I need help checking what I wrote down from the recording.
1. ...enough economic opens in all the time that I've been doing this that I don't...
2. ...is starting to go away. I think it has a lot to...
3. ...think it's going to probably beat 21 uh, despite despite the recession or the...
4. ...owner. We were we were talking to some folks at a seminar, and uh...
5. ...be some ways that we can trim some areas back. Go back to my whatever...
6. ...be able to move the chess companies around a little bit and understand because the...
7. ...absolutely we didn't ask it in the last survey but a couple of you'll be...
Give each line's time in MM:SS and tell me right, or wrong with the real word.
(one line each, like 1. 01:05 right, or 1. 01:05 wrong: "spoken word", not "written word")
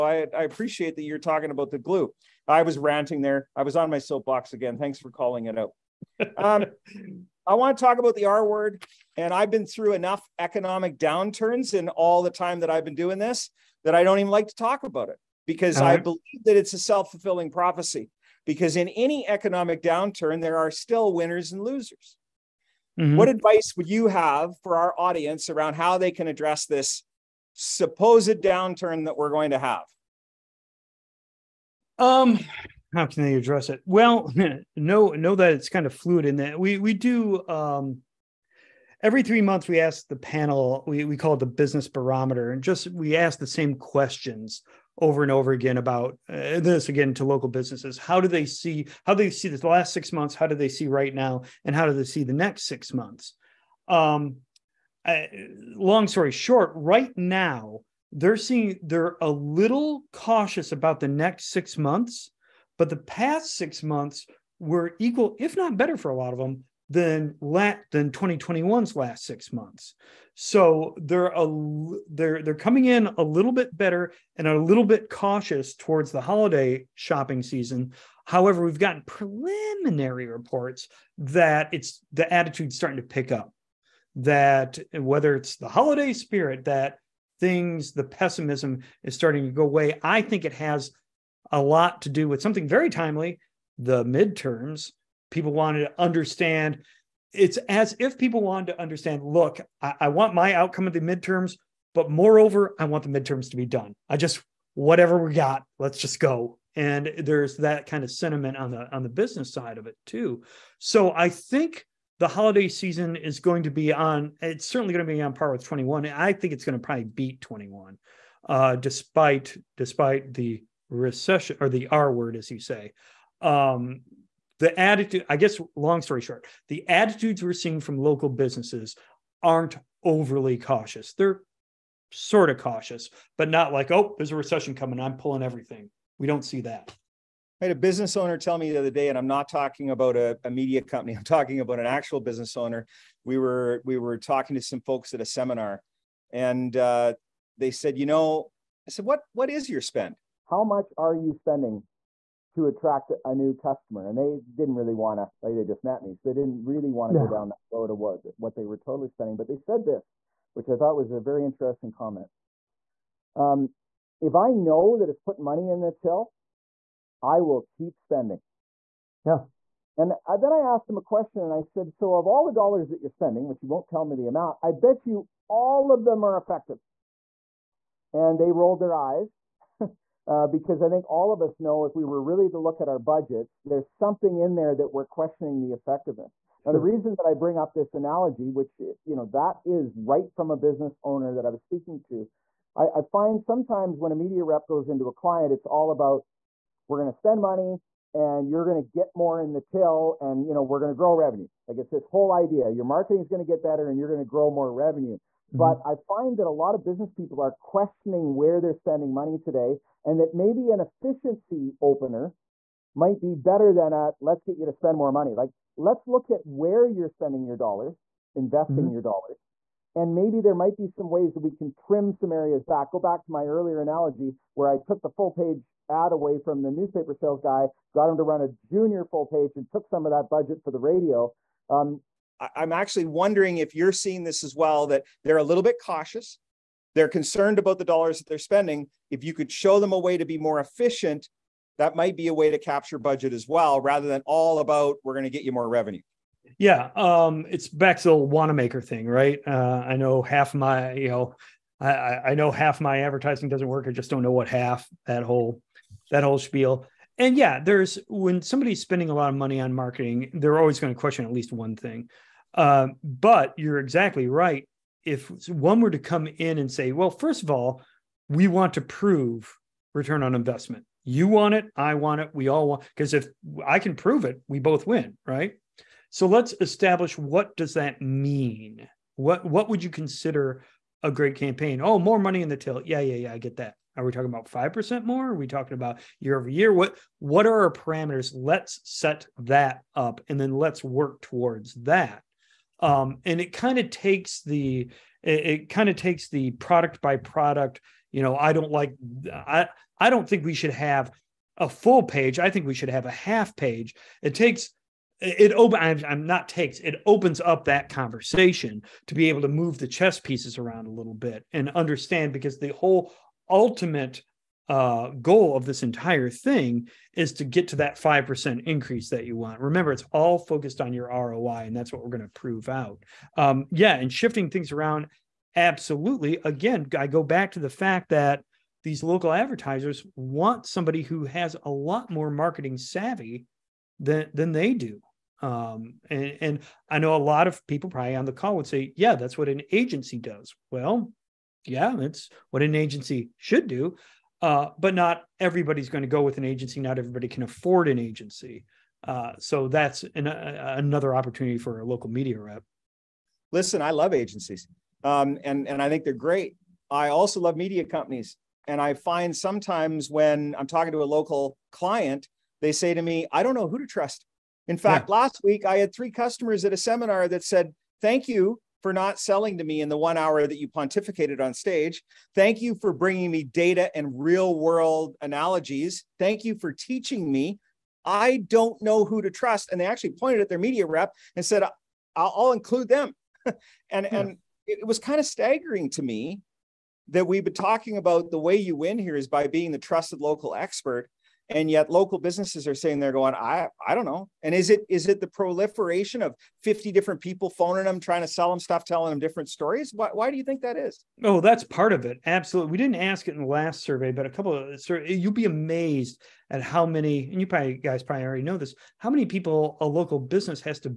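1. 00:09 wrong: "downturns", not "opens"
2. 01:29 right
3. 01:56 right
4. 02:22 right
5. 03:40 wrong: "earlier", not "whatever"
6. 05:09 wrong: "pieces", not "companies"
7. 06:42 right.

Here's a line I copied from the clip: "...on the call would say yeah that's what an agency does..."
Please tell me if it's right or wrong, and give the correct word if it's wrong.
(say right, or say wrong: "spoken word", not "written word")
right.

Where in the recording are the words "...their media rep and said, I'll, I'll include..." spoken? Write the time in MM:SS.
06:20.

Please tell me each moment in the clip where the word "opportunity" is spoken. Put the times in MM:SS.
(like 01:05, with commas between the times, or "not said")
05:51.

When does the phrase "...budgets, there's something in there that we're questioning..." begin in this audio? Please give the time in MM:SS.
03:02.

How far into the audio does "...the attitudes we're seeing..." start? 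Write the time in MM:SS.
02:06.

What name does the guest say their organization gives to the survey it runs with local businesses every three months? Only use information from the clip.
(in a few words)
business barometer.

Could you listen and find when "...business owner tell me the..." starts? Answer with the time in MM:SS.
02:17.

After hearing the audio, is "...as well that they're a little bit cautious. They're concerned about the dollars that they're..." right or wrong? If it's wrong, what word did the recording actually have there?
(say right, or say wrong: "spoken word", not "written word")
right.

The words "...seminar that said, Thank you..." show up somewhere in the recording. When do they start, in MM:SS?
06:06.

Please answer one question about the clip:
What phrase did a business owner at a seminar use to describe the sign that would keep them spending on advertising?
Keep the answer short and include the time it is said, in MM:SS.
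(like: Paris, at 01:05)
putting money in the till, at 02:45.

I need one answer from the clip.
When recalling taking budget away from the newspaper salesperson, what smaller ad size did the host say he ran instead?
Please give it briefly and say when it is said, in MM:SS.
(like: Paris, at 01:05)
junior full page, at 03:48.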